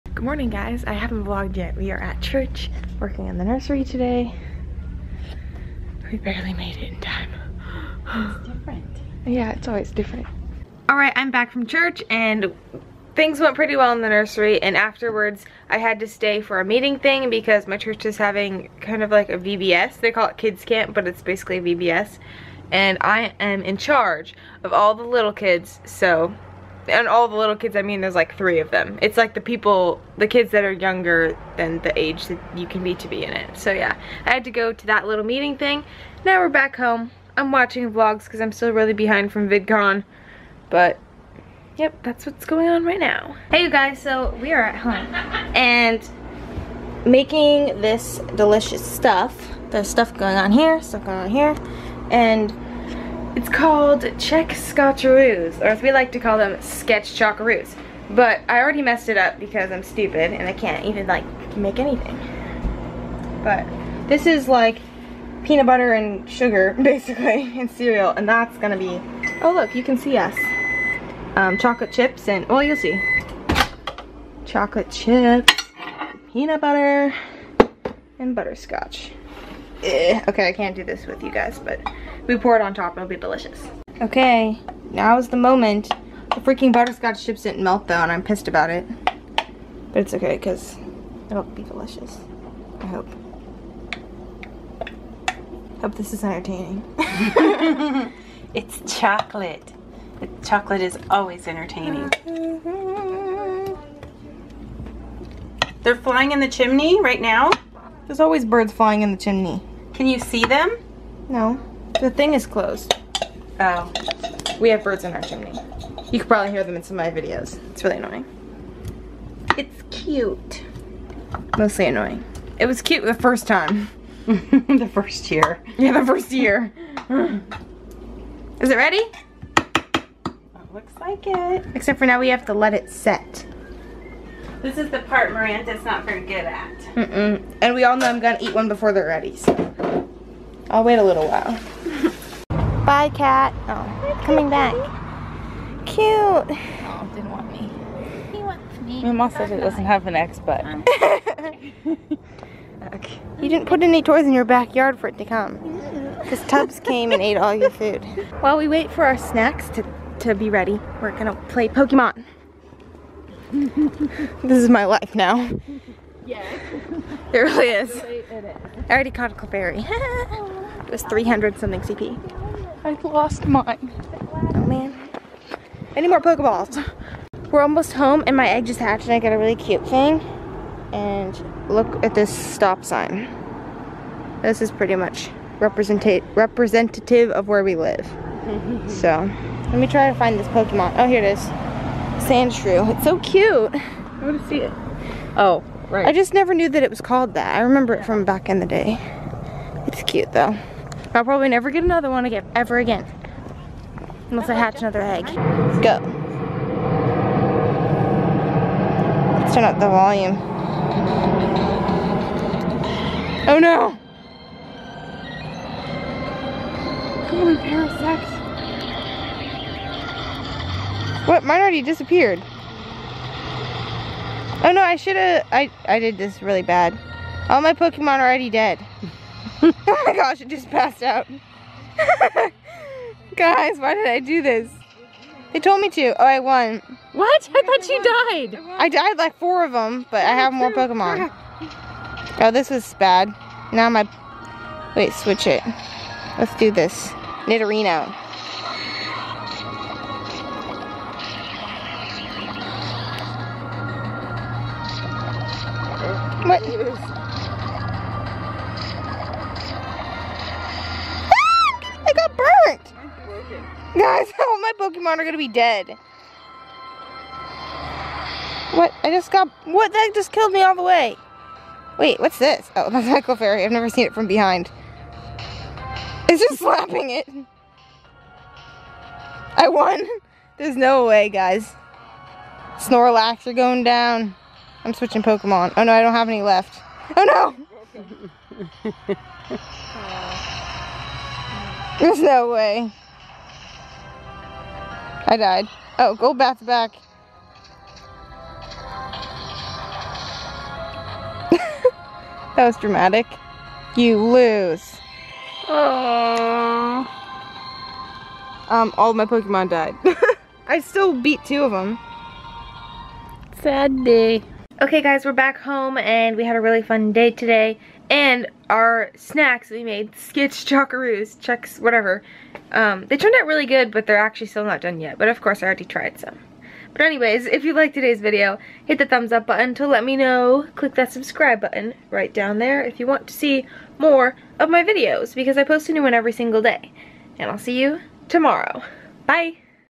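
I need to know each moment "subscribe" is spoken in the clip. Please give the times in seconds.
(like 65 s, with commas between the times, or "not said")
331 s.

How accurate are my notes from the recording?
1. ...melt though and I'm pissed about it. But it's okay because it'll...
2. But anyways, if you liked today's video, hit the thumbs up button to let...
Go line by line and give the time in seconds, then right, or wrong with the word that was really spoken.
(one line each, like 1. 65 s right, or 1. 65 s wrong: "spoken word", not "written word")
1. 87 s right
2. 326 s right.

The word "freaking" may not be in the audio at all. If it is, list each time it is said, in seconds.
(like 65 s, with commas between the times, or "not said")
86 s.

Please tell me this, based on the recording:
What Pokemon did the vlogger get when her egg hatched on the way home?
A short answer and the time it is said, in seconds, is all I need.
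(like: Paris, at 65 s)
Sandshrew, at 192 s.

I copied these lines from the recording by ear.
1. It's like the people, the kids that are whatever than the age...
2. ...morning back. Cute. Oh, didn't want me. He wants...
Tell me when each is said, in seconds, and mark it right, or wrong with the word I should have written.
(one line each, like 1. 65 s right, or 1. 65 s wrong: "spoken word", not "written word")
1. 29 s wrong: "younger", not "whatever"
2. 144 s wrong: "coming", not "morning".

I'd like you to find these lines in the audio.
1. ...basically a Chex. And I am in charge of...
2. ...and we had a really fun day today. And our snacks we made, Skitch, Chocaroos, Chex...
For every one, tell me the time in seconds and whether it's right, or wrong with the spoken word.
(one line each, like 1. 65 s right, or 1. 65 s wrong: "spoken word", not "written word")
1. 21 s wrong: "VBS", not "Chex"
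2. 315 s right.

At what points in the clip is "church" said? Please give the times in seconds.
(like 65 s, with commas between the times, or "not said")
2 s, 11 s, 17 s.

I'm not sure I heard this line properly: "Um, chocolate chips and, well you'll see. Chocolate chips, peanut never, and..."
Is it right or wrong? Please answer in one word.
wrong.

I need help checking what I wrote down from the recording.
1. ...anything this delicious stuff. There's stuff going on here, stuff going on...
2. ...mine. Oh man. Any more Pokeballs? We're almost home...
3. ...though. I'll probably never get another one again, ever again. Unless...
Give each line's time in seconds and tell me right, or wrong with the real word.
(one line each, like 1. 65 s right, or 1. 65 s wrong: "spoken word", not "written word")
1. 47 s wrong: "making", not "anything"
2. 173 s right
3. 200 s right.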